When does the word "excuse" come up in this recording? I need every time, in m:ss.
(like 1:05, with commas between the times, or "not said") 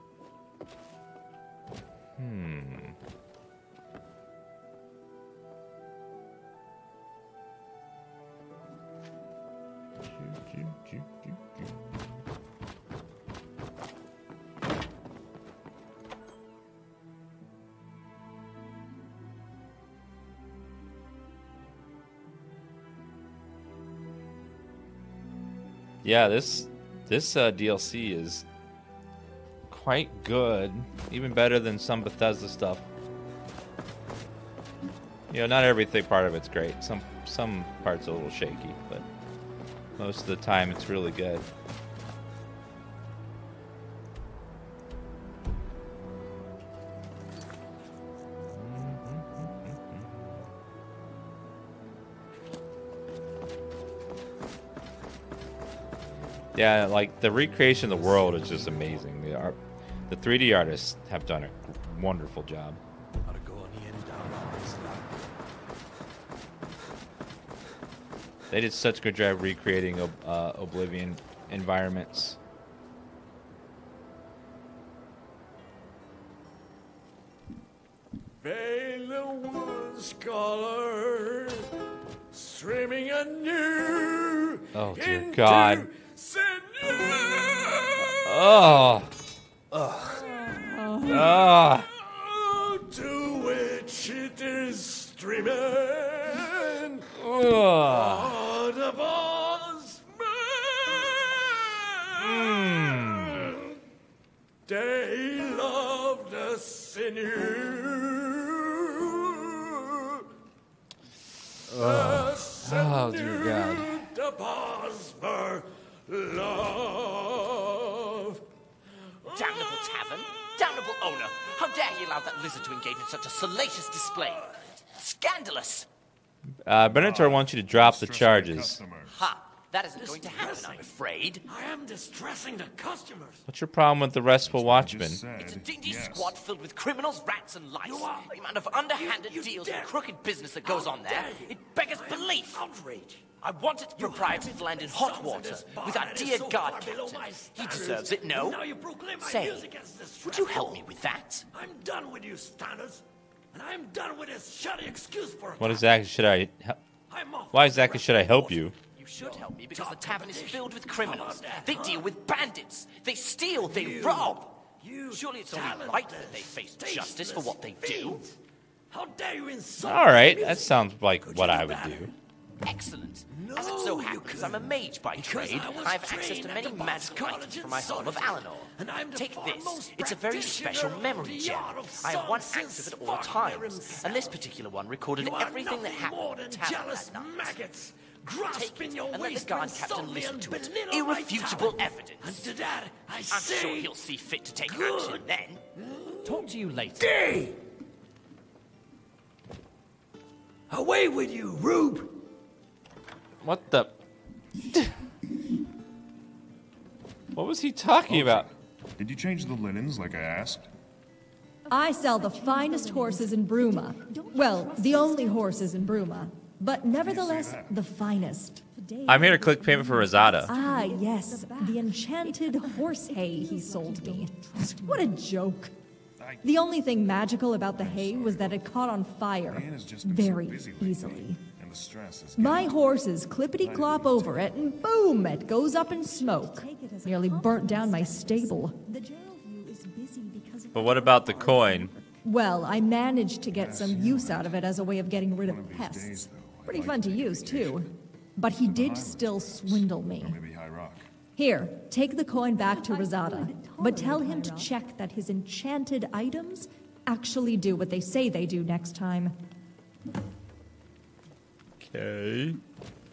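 2:34.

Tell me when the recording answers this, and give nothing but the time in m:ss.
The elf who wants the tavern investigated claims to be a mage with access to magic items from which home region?
2:58.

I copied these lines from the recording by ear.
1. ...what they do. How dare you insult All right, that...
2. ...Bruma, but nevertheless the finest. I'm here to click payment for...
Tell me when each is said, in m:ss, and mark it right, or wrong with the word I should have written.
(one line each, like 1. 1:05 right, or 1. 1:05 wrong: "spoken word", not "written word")
1. 2:47 right
2. 3:35 right.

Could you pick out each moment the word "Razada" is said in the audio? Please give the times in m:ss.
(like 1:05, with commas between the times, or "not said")
3:40, 4:12.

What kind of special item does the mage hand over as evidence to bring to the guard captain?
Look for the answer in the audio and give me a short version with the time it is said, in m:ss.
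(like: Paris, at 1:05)
Memory gem, at 3:01.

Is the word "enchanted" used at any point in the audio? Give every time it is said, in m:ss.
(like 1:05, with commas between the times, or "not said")
3:41, 4:15.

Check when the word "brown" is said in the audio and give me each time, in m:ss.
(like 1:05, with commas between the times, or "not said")
not said.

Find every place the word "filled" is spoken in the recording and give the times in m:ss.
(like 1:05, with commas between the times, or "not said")
2:16, 2:40.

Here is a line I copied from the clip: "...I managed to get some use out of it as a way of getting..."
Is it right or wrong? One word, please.
right.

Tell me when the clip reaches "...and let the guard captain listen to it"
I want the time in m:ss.
3:09.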